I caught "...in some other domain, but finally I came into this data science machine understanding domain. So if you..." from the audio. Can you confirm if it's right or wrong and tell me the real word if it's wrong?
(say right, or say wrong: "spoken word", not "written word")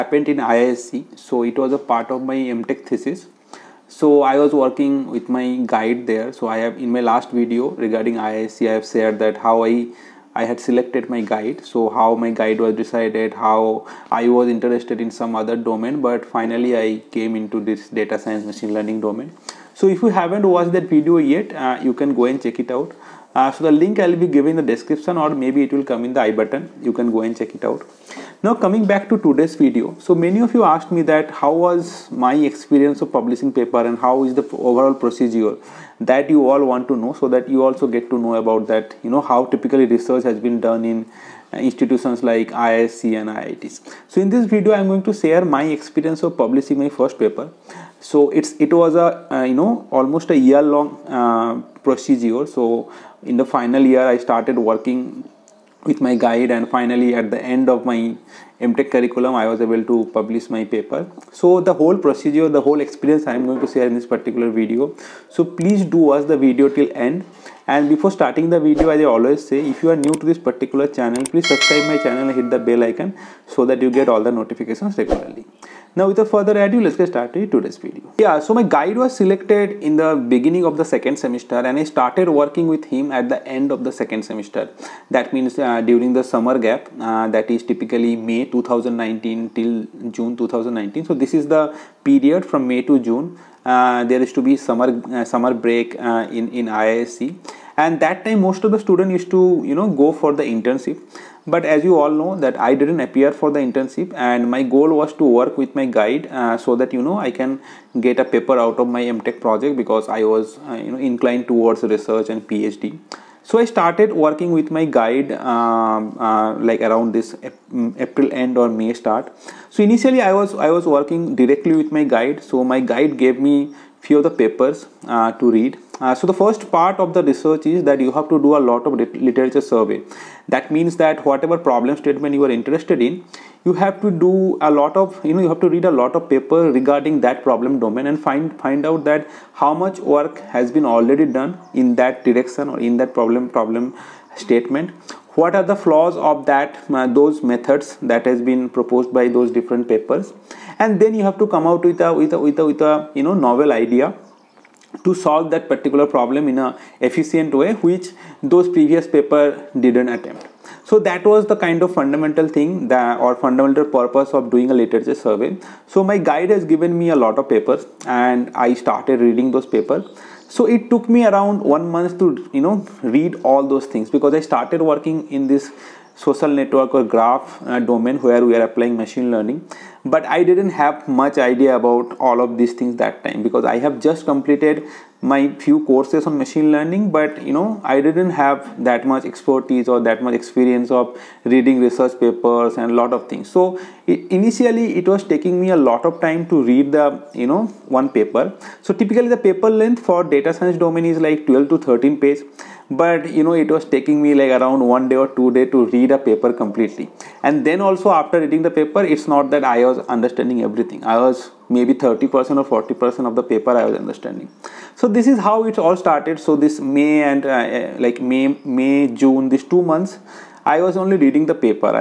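wrong: "learning", not "understanding".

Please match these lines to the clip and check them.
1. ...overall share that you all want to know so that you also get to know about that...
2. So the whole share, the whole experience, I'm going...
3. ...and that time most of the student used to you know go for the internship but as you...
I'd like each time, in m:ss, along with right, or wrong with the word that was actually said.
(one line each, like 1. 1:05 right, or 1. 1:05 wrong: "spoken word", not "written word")
1. 0:34 wrong: "procedure", not "share"
2. 1:01 wrong: "procedure", not "share"
3. 1:37 right.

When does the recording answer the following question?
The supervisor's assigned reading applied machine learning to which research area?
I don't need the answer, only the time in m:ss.
2:56.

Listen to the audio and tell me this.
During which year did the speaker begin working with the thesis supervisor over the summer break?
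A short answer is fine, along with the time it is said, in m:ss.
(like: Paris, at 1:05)
2019, at 1:28.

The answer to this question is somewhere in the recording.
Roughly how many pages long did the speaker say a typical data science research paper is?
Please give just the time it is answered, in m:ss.
3:21.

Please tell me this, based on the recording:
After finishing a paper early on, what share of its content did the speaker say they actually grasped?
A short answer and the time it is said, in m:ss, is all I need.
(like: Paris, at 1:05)
30% or 40%, at 3:31.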